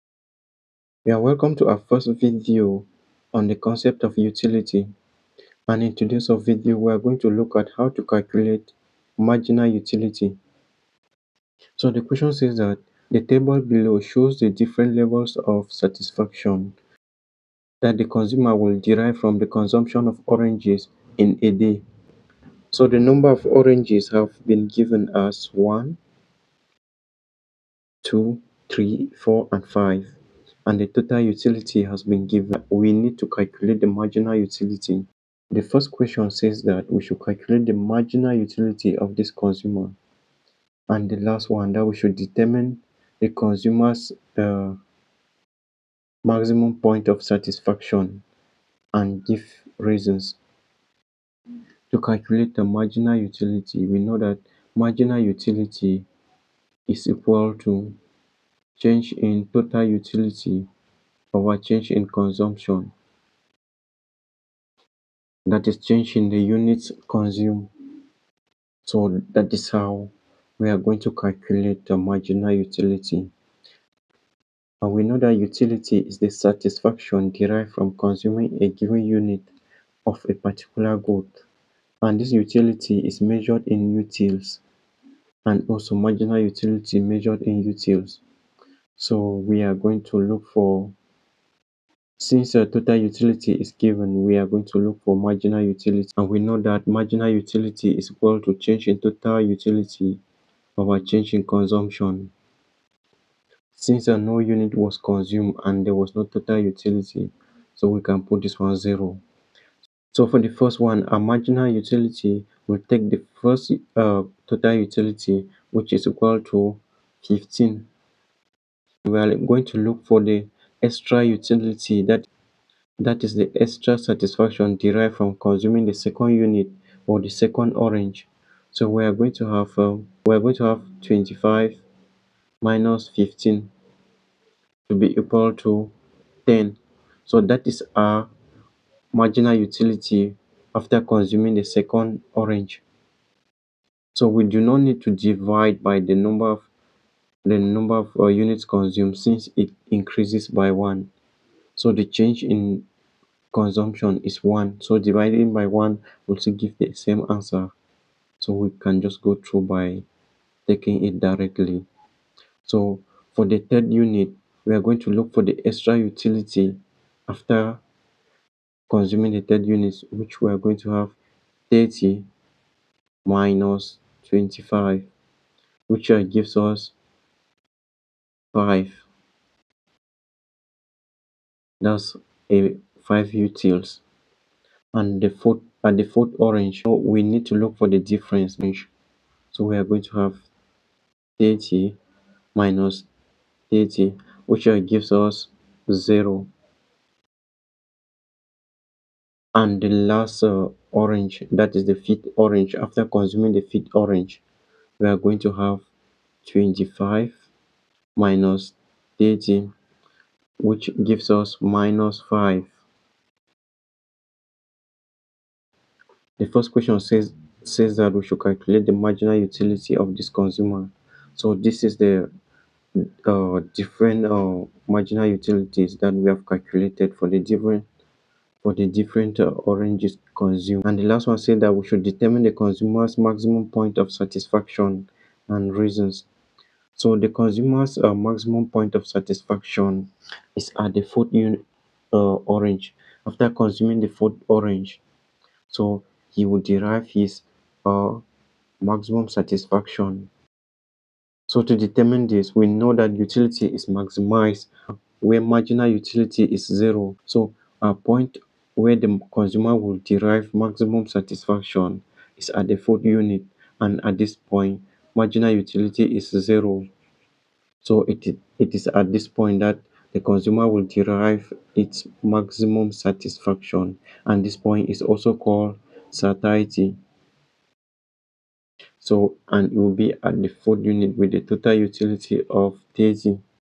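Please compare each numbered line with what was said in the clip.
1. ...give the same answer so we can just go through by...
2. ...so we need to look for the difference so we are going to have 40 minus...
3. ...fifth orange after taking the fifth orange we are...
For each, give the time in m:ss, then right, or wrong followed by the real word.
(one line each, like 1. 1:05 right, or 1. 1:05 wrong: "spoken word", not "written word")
1. 2:36 right
2. 3:06 wrong: "30", not "40"
3. 3:21 wrong: "consuming", not "taking".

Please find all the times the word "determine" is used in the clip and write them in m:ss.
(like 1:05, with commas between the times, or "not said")
0:42, 3:52, 4:11.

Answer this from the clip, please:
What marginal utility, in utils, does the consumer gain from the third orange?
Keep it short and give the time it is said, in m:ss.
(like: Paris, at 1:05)
5, at 3:03.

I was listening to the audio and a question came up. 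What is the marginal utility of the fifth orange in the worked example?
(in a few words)
-5.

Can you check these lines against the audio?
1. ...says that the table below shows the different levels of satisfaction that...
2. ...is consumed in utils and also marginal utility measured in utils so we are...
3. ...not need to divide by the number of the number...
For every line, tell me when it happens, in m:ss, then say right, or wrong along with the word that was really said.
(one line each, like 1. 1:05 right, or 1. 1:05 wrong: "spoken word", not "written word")
1. 0:12 right
2. 1:23 wrong: "measured", not "consumed"
3. 2:24 right.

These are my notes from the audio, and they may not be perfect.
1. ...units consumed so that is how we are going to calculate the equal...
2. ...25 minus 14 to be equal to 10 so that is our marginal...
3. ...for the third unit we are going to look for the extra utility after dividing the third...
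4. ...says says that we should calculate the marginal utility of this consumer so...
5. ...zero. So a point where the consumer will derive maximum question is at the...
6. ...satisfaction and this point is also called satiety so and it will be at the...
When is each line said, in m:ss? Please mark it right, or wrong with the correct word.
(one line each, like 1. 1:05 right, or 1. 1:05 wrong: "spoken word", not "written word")
1. 1:06 wrong: "marginal", not "equal"
2. 2:11 wrong: "15", not "14"
3. 2:43 wrong: "consuming", not "dividing"
4. 3:36 right
5. 4:16 wrong: "satisfaction", not "question"
6. 4:32 right.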